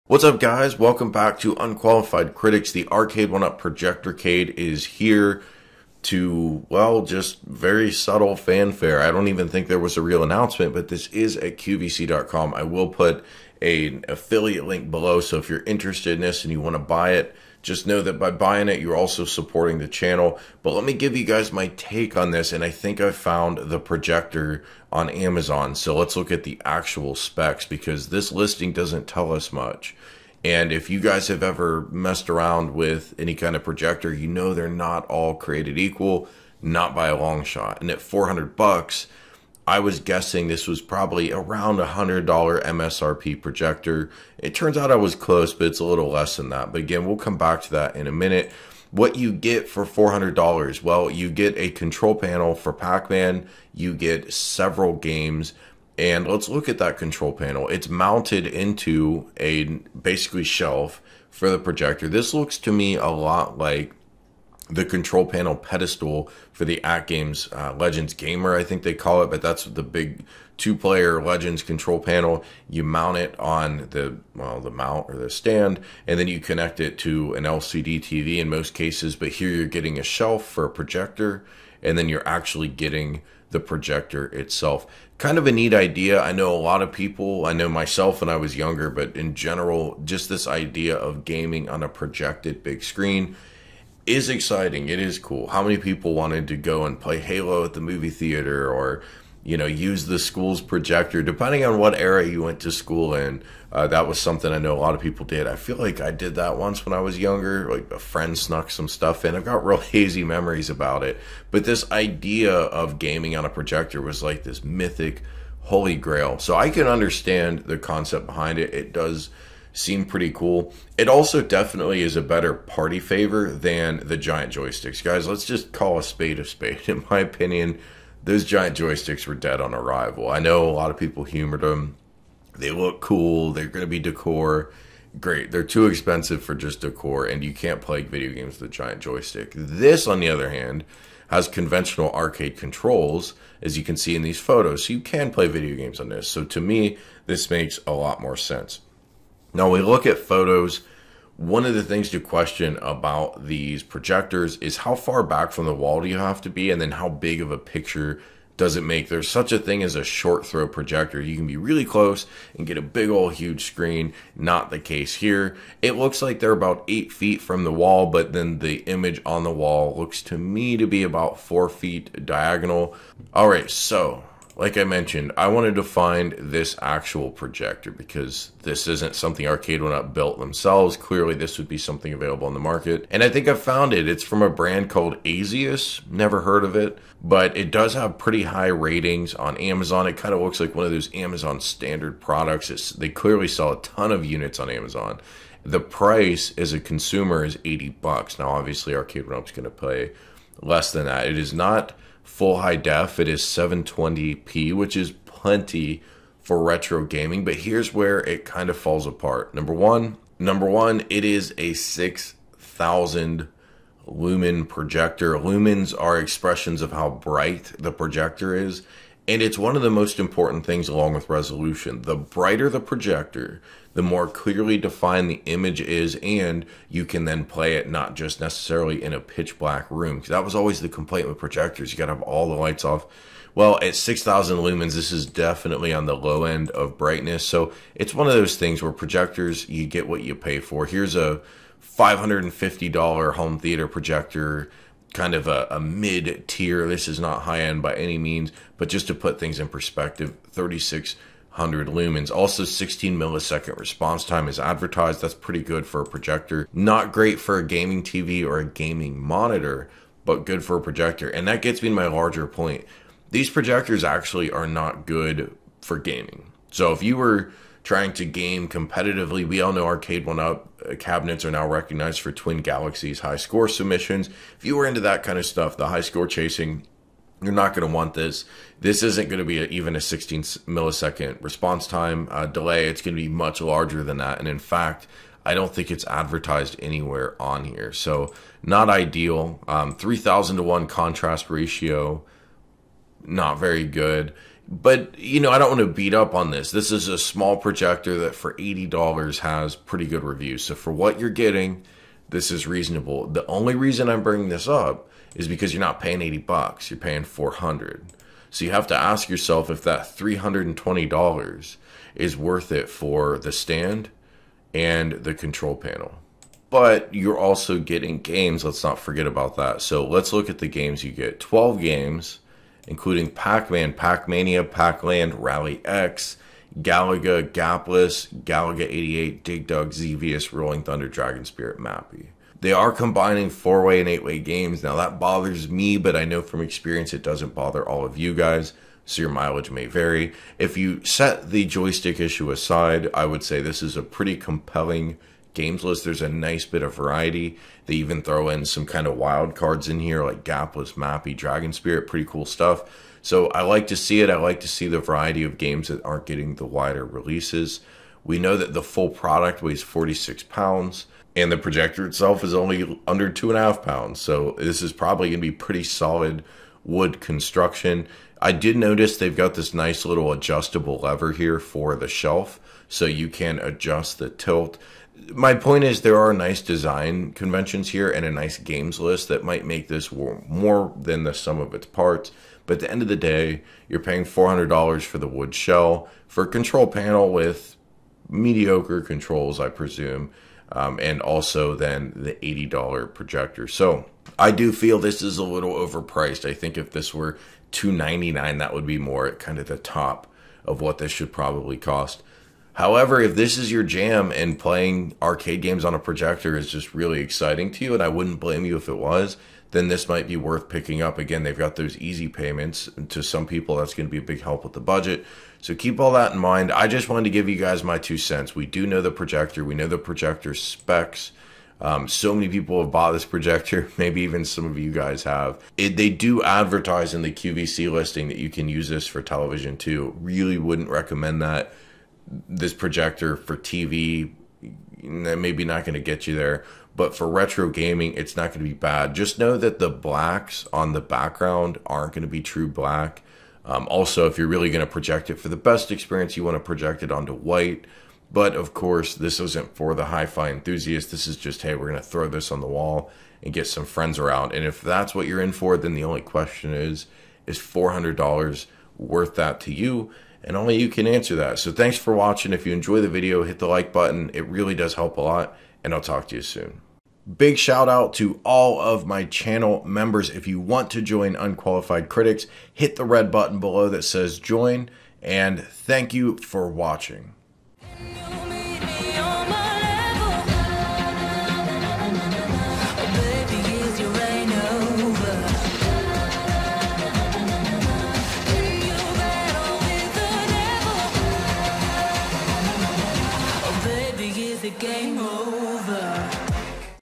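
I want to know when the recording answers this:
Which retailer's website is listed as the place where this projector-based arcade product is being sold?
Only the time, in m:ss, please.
0:11.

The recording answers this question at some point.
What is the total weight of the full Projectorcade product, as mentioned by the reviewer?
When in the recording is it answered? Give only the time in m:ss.
5:59.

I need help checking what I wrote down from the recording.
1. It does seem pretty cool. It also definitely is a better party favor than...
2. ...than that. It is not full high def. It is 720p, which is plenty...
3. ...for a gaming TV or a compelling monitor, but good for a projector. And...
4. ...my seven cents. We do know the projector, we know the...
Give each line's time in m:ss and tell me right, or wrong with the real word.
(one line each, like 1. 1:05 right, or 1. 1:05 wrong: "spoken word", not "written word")
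1. 1:58 right
2. 3:20 right
3. 4:17 wrong: "gaming", not "compelling"
4. 6:57 wrong: "two", not "seven".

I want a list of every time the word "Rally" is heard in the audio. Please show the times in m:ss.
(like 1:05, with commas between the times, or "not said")
5:25.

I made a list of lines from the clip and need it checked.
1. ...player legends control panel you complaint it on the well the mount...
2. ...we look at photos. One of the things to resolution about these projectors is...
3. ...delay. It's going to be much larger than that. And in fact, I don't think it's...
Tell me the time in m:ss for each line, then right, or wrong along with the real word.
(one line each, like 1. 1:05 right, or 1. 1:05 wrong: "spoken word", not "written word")
1. 1:10 wrong: "mount", not "complaint"
2. 2:29 wrong: "question", not "resolution"
3. 4:42 right.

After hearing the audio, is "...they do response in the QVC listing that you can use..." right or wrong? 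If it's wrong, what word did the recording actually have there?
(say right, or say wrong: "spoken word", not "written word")
wrong: "advertise", not "response".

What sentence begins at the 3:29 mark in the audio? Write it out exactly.
Number one, number one, it is a 6,000 lumen projector.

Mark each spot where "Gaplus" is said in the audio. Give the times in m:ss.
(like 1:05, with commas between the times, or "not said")
5:27, 5:50.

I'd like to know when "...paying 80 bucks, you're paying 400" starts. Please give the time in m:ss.
5:05.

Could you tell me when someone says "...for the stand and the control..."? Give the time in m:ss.
5:12.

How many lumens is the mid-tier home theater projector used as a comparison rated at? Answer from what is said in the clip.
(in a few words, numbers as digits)
3600.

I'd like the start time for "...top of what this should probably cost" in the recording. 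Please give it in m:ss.
6:39.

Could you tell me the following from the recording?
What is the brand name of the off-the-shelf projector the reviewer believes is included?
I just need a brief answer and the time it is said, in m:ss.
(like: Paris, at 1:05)
Asius, at 3:05.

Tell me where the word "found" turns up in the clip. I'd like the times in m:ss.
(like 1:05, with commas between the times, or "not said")
0:23, 3:03.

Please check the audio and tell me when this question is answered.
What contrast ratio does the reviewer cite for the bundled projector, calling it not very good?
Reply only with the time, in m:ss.
4:49.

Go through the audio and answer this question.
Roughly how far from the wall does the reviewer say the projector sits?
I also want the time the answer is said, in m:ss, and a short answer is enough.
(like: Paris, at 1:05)
8 feet, at 2:46.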